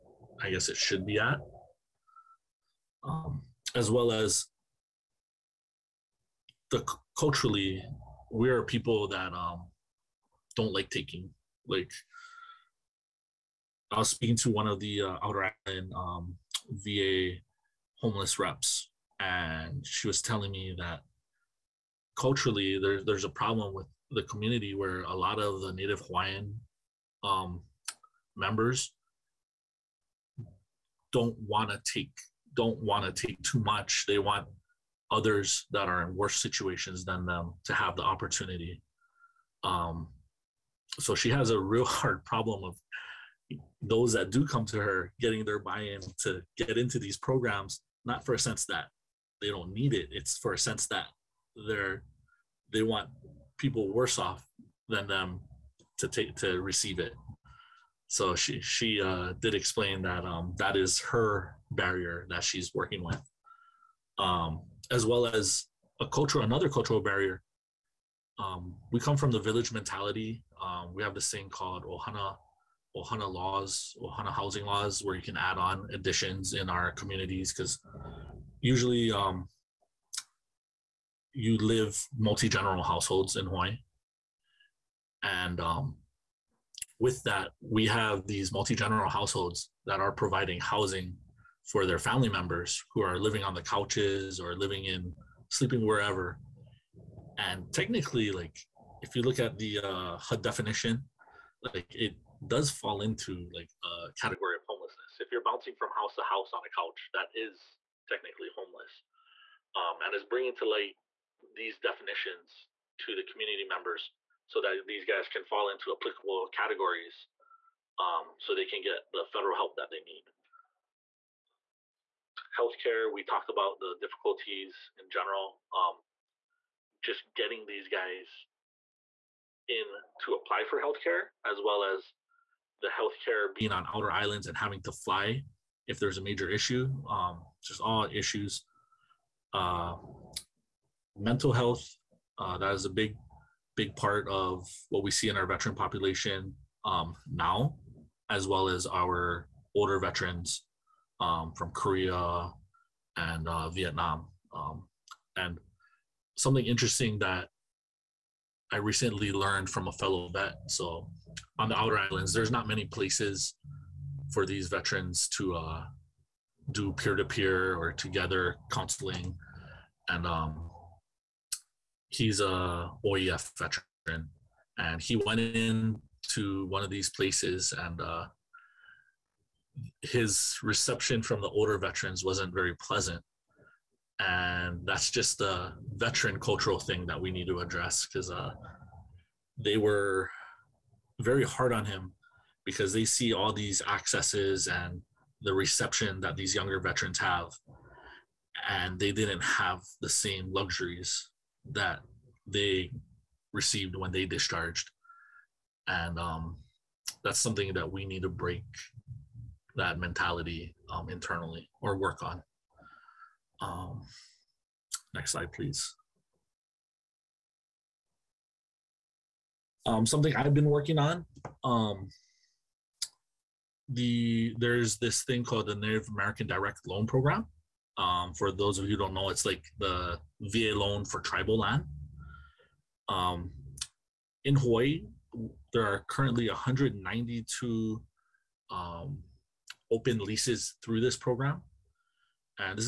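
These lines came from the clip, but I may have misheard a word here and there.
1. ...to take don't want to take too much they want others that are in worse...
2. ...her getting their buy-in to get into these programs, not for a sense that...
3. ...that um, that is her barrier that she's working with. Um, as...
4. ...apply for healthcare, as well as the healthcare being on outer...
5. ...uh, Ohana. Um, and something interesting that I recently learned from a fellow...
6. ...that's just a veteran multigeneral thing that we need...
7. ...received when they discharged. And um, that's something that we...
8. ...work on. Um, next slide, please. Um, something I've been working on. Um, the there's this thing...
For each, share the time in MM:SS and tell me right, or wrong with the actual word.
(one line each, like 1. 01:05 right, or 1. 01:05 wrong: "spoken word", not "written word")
1. 00:31 right
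2. 00:44 right
3. 01:00 right
4. 02:10 right
5. 02:33 wrong: "Vietnam", not "Ohana"
6. 03:04 wrong: "cultural", not "multigeneral"
7. 03:23 right
8. 03:31 right.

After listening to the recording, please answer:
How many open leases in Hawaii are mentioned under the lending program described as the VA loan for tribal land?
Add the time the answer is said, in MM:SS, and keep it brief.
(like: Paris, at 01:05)
192, at 03:56.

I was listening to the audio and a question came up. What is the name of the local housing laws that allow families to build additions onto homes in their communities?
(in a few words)
Ohana housing laws.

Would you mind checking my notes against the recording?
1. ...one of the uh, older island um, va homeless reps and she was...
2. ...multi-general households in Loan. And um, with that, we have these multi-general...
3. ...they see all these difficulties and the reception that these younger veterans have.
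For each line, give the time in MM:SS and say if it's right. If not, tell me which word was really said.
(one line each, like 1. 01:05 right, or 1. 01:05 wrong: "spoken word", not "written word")
1. 00:14 wrong: "outer", not "older"
2. 01:22 wrong: "Hawaii", not "Loan"
3. 03:12 wrong: "accesses", not "difficulties".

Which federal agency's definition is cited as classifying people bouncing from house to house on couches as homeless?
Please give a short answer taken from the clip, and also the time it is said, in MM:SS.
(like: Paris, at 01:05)
HUD, at 01:40.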